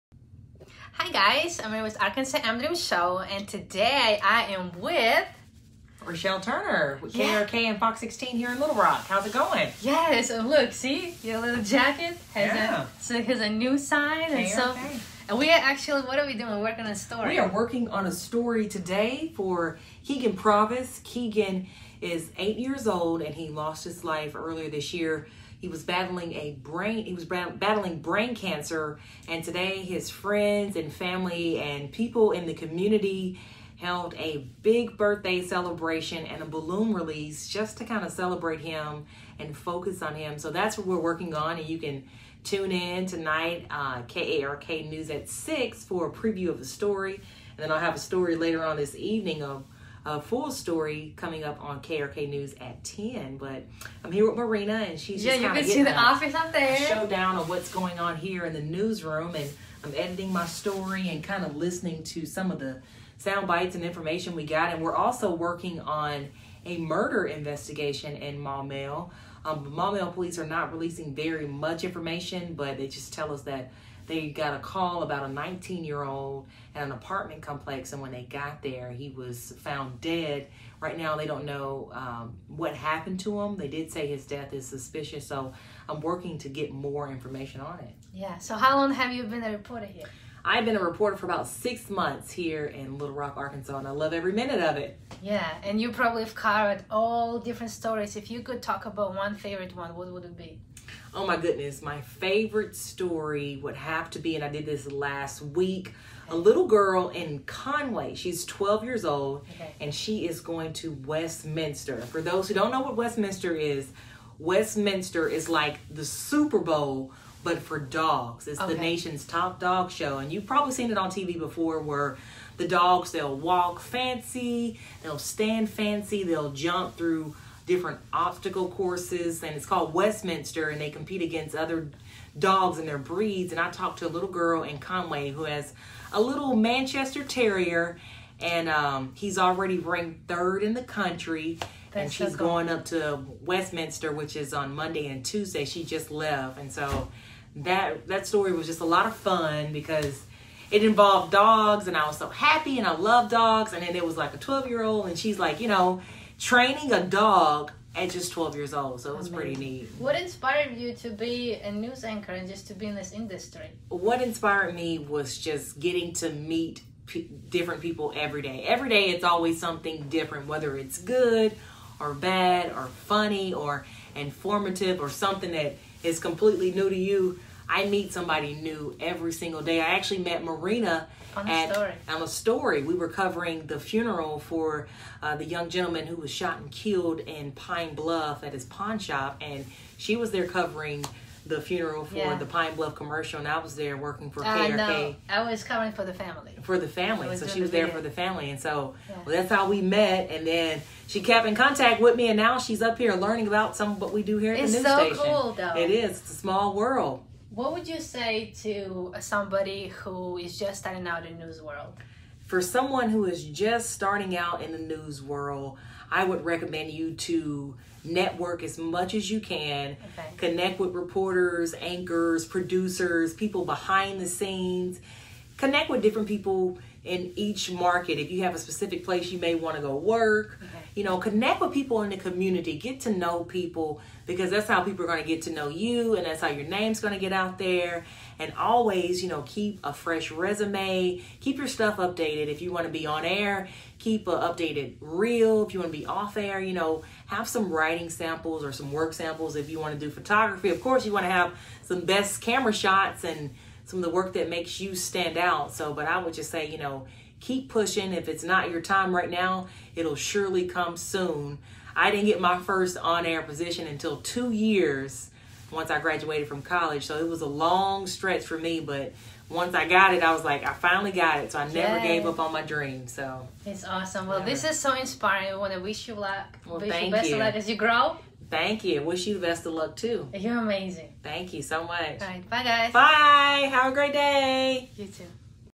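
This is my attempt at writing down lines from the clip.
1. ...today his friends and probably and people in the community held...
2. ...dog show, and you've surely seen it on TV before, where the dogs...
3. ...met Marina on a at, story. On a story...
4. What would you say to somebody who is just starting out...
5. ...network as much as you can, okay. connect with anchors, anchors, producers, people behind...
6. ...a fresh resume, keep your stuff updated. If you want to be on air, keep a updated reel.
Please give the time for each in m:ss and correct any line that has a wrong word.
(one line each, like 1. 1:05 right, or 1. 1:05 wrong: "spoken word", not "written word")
1. 0:29 wrong: "family", not "probably"
2. 1:59 wrong: "probably", not "surely"
3. 3:00 right
4. 3:27 right
5. 3:38 wrong: "reporters", not "anchors"
6. 3:59 right.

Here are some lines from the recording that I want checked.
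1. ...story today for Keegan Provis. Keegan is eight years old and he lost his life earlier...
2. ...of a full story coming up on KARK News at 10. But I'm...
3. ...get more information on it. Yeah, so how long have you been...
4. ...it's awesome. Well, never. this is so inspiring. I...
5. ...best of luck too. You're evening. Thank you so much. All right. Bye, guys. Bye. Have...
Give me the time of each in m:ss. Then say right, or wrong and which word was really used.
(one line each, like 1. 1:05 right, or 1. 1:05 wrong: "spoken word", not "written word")
1. 0:18 right
2. 0:49 right
3. 1:26 right
4. 4:33 right
5. 4:39 wrong: "amazing", not "evening".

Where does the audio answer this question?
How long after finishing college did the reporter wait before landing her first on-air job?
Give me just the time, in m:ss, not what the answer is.
4:24.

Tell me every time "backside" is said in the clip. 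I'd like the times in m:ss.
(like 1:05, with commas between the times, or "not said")
not said.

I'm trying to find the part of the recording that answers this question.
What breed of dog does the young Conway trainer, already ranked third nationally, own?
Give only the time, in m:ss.
2:16.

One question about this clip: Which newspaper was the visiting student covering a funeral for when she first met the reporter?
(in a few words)
Pine Bluff Commercial.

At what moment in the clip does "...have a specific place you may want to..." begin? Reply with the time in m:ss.
3:48.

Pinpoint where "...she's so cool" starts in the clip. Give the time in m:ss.
2:22.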